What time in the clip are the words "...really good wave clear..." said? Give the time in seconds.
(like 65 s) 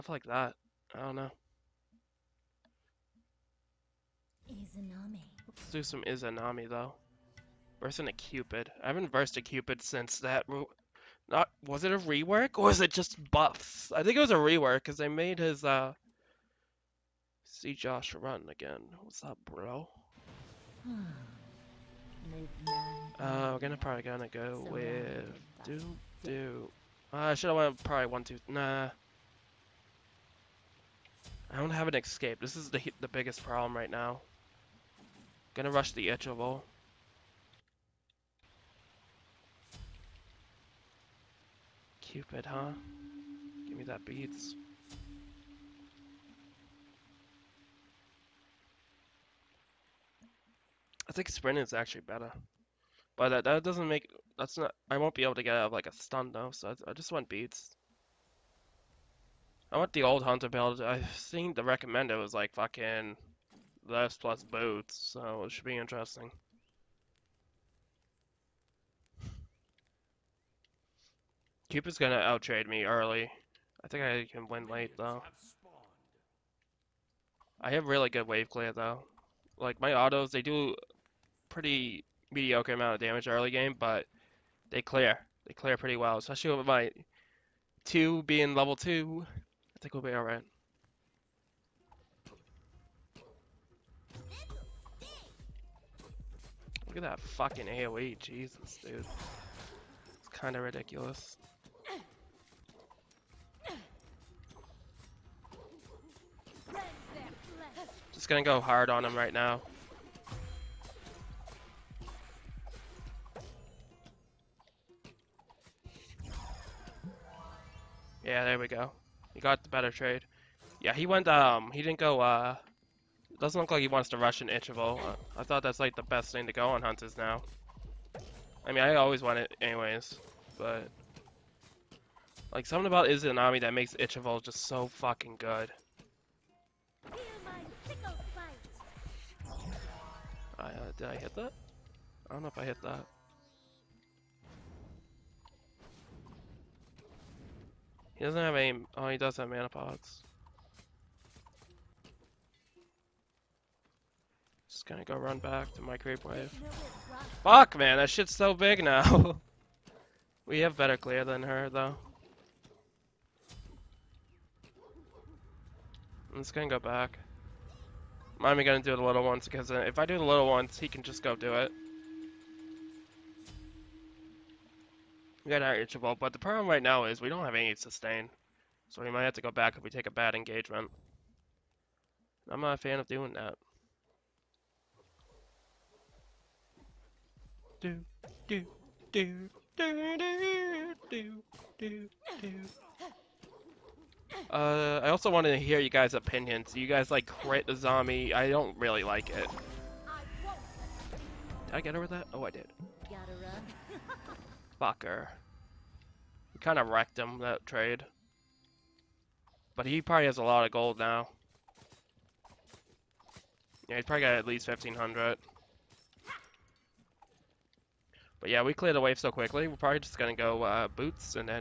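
77 s.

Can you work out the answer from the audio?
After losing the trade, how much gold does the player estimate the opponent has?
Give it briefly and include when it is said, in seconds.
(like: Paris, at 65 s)
1,500, at 214 s.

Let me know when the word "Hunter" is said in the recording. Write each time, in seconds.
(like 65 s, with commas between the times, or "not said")
60 s, 126 s.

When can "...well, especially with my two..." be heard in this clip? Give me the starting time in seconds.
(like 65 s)
85 s.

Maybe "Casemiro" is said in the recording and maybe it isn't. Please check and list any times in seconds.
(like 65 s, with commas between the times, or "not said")
not said.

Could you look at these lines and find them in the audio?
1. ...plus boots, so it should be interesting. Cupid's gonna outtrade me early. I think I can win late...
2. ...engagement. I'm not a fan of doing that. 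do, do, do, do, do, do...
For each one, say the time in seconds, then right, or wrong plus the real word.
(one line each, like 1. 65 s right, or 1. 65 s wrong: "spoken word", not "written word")
1. 64 s right
2. 180 s right.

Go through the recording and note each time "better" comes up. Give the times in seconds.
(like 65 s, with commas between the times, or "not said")
52 s, 119 s, 160 s.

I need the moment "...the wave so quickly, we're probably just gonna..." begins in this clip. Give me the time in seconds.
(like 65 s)
218 s.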